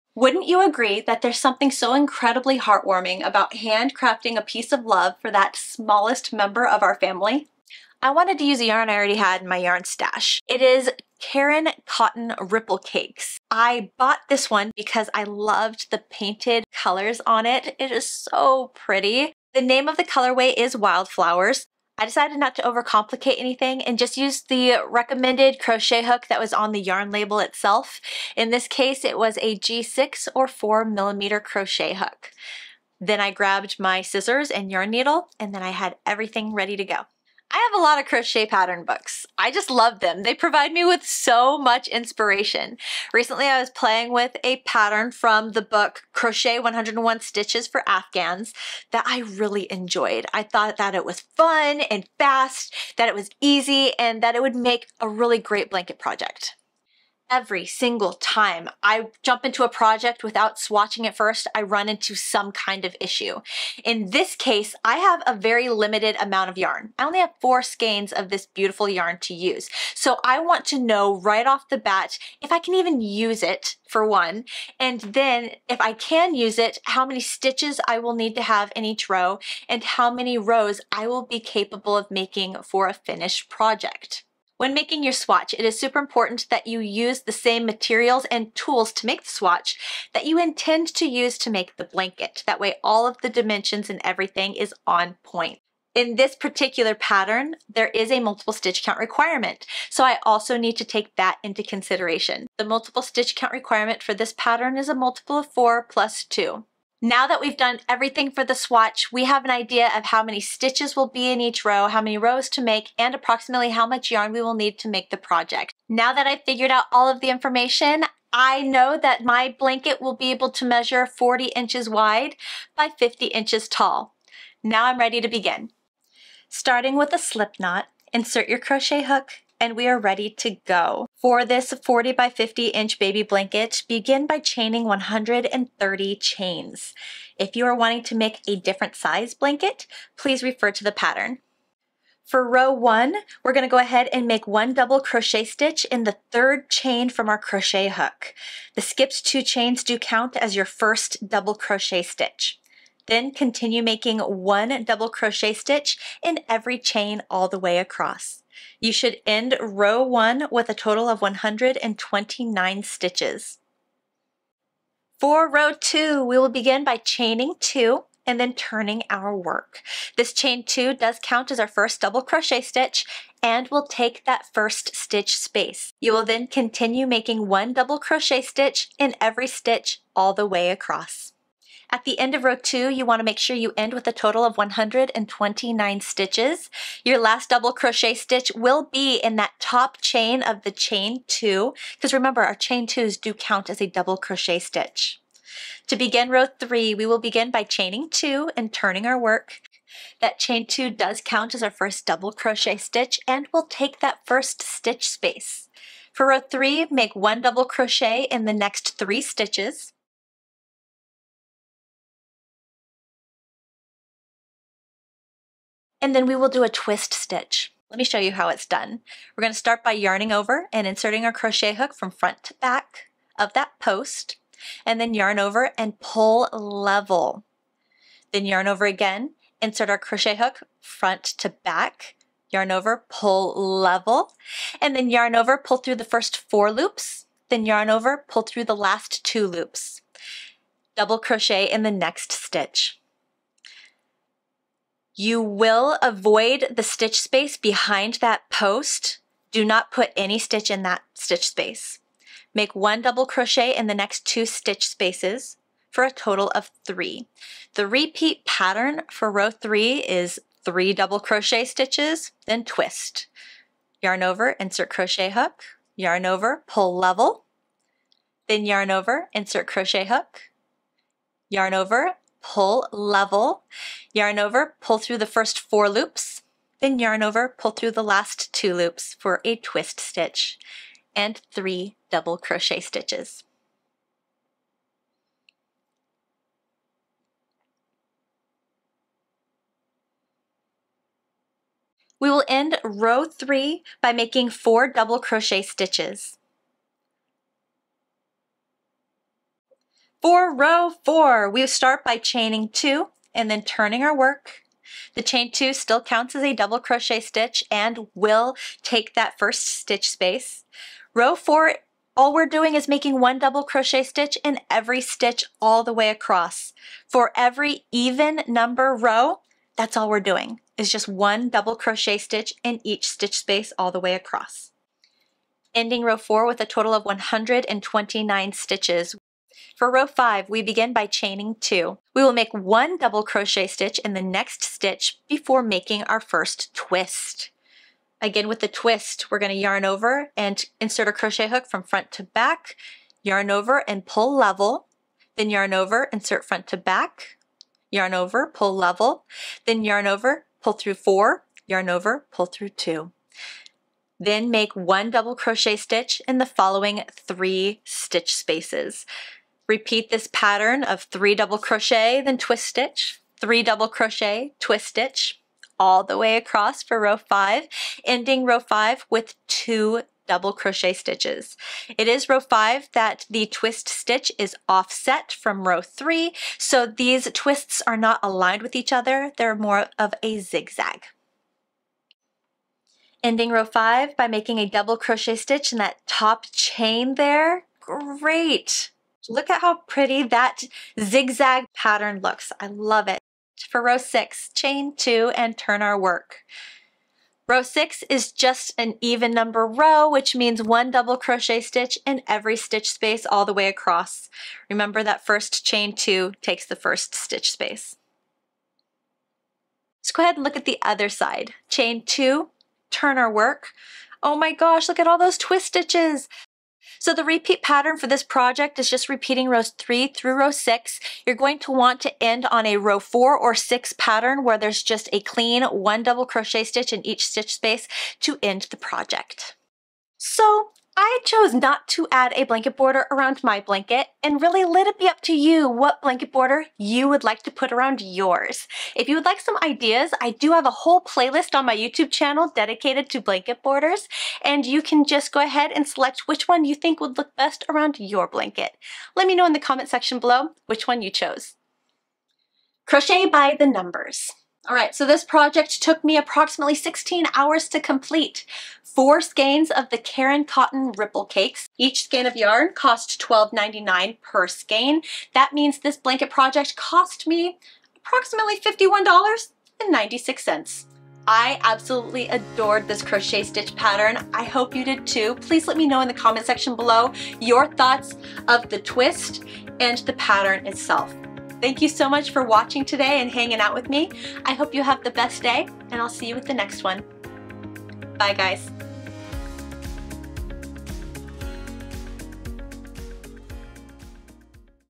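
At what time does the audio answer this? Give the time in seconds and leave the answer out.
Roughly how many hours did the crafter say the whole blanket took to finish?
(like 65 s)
456 s.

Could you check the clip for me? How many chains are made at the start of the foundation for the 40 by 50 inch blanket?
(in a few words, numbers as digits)
130.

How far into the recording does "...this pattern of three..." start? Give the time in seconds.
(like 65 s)
360 s.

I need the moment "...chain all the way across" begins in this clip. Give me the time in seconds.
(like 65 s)
156 s.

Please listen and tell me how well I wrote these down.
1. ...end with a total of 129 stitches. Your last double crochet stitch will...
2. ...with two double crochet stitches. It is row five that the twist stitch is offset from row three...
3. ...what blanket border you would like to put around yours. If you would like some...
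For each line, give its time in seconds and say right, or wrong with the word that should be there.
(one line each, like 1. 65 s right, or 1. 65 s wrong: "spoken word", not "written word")
1. 183 s right
2. 369 s right
3. 435 s right.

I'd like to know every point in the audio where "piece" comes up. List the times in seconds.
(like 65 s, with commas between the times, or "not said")
4 s.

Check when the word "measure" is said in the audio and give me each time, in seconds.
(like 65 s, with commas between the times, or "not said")
120 s.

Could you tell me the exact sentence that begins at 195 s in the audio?
To begin row three, we will begin by chaining two and turning our work.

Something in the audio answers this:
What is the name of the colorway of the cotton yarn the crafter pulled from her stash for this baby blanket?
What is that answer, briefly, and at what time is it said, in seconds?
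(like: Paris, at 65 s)
Wildflowers, at 20 s.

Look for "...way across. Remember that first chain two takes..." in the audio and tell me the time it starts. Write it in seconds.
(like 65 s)
403 s.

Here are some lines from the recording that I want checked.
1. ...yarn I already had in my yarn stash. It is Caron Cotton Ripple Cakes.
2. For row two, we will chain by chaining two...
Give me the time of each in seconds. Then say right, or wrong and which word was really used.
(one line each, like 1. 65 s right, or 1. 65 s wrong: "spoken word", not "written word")
1. 8 s right
2. 165 s wrong: "begin", not "chain".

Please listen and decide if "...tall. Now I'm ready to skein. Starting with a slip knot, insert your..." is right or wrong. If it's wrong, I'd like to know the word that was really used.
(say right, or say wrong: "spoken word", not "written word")
wrong: "begin", not "skein".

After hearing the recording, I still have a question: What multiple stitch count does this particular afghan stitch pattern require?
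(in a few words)
multiple of 4 plus 2.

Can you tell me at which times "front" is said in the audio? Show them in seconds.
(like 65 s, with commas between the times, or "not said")
222 s, 230 s, 341 s, 346 s.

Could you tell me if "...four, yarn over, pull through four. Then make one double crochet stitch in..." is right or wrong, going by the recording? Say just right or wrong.
wrong.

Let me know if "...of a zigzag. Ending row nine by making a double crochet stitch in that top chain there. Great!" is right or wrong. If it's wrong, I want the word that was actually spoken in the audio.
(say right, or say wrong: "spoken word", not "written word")
wrong: "five", not "nine".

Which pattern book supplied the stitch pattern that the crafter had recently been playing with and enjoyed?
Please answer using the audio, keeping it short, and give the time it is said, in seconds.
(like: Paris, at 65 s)
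Crochet 101 Stitches for Afghans, at 46 s.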